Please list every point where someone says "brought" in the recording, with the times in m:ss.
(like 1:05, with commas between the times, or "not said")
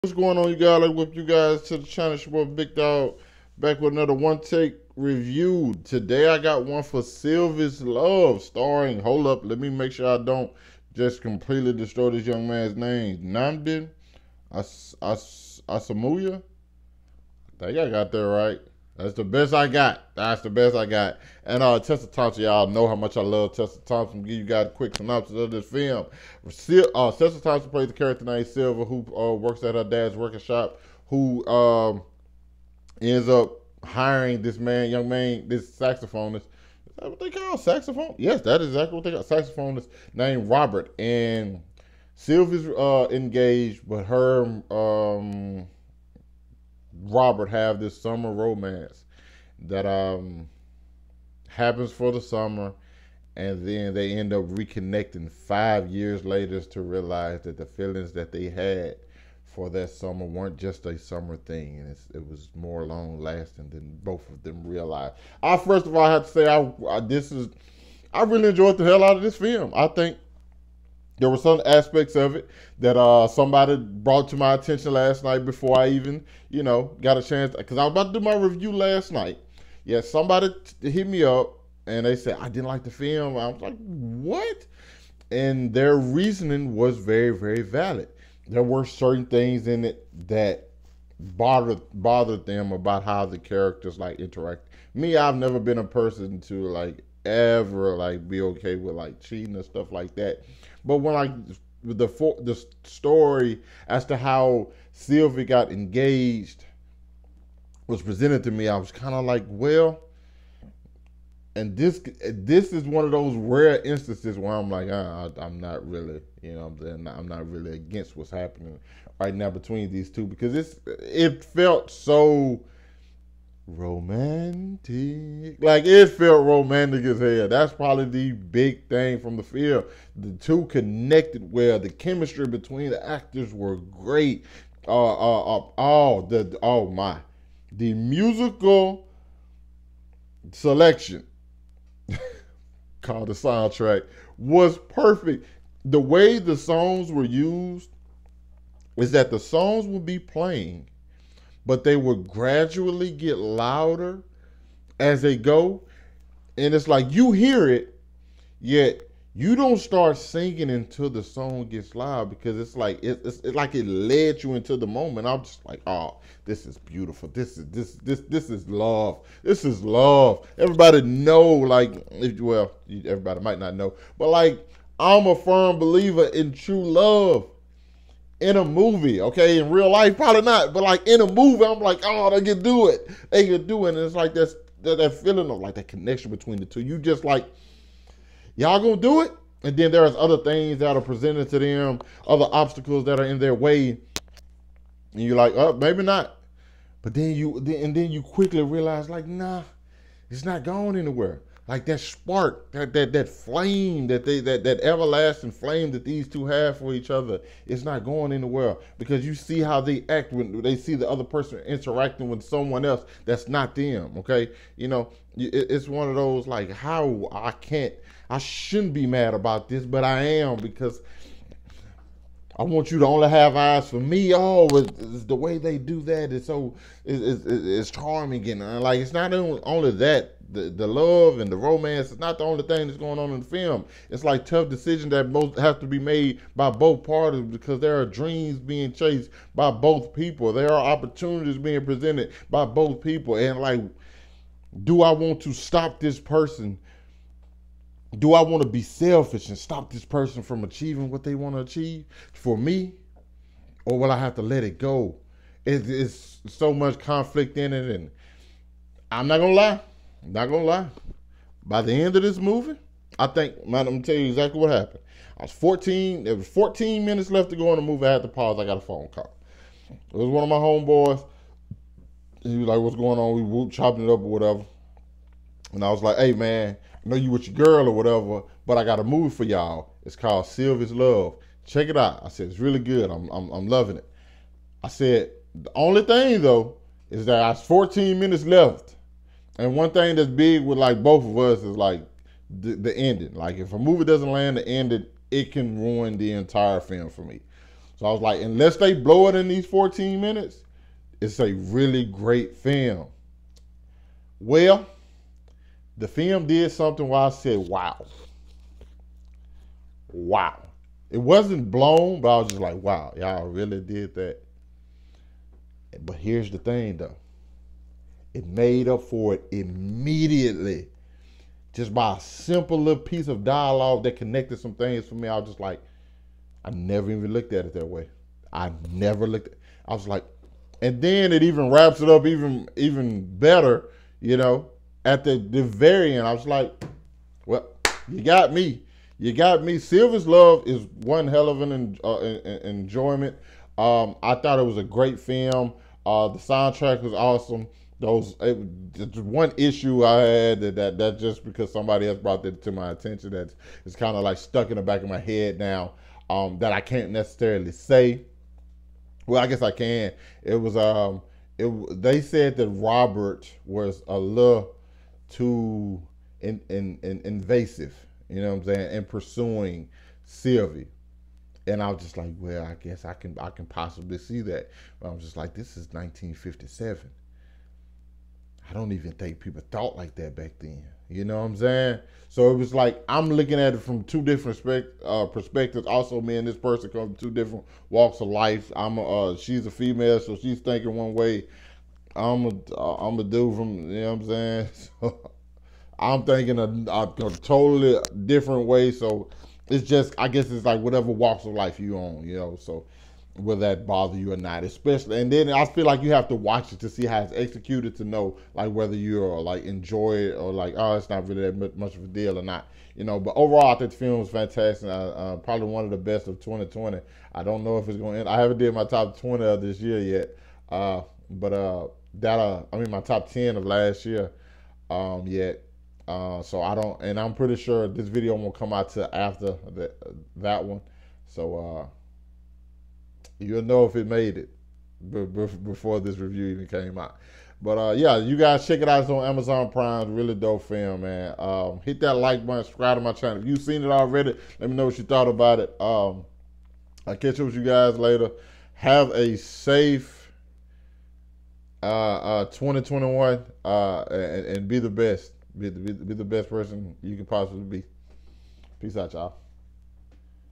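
1:13, 5:52.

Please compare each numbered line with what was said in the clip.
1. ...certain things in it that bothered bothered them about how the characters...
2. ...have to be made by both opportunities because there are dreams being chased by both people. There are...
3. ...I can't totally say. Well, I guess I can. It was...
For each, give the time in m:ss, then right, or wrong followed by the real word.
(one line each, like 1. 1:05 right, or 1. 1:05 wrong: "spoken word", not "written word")
1. 1:28 right
2. 3:55 wrong: "parties", not "opportunities"
3. 5:56 wrong: "necessarily", not "totally".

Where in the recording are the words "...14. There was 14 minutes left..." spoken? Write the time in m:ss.
4:25.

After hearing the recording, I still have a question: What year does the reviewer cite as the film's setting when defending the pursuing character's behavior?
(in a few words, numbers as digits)
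1957.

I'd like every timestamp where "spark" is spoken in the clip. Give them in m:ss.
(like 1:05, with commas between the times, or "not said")
3:22.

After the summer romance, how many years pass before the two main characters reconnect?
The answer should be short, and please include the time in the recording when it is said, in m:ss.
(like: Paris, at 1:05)
5, at 0:55.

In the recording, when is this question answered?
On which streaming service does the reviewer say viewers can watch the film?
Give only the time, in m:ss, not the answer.
7:19.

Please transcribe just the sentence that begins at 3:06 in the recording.
You just like, y'all gonna do it?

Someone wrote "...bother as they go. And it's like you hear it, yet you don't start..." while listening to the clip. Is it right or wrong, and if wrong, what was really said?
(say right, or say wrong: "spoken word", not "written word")
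wrong: "louder", not "bother".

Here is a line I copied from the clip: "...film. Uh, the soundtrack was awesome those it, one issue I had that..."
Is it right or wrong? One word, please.
right.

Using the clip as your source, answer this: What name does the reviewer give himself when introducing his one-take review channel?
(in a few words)
Big Dog.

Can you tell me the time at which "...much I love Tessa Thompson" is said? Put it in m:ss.
0:22.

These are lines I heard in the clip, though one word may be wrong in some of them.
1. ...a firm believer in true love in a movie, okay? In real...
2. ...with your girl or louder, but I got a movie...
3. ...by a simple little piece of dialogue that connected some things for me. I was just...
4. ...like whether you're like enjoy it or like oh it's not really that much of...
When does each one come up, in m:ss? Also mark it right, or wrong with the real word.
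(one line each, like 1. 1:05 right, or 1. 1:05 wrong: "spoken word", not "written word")
1. 2:55 right
2. 4:37 wrong: "whatever", not "louder"
3. 5:21 right
4. 6:48 right.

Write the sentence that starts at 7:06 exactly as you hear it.
Uh, so I don't, and I'm pretty sure this video won't come out to after that that one.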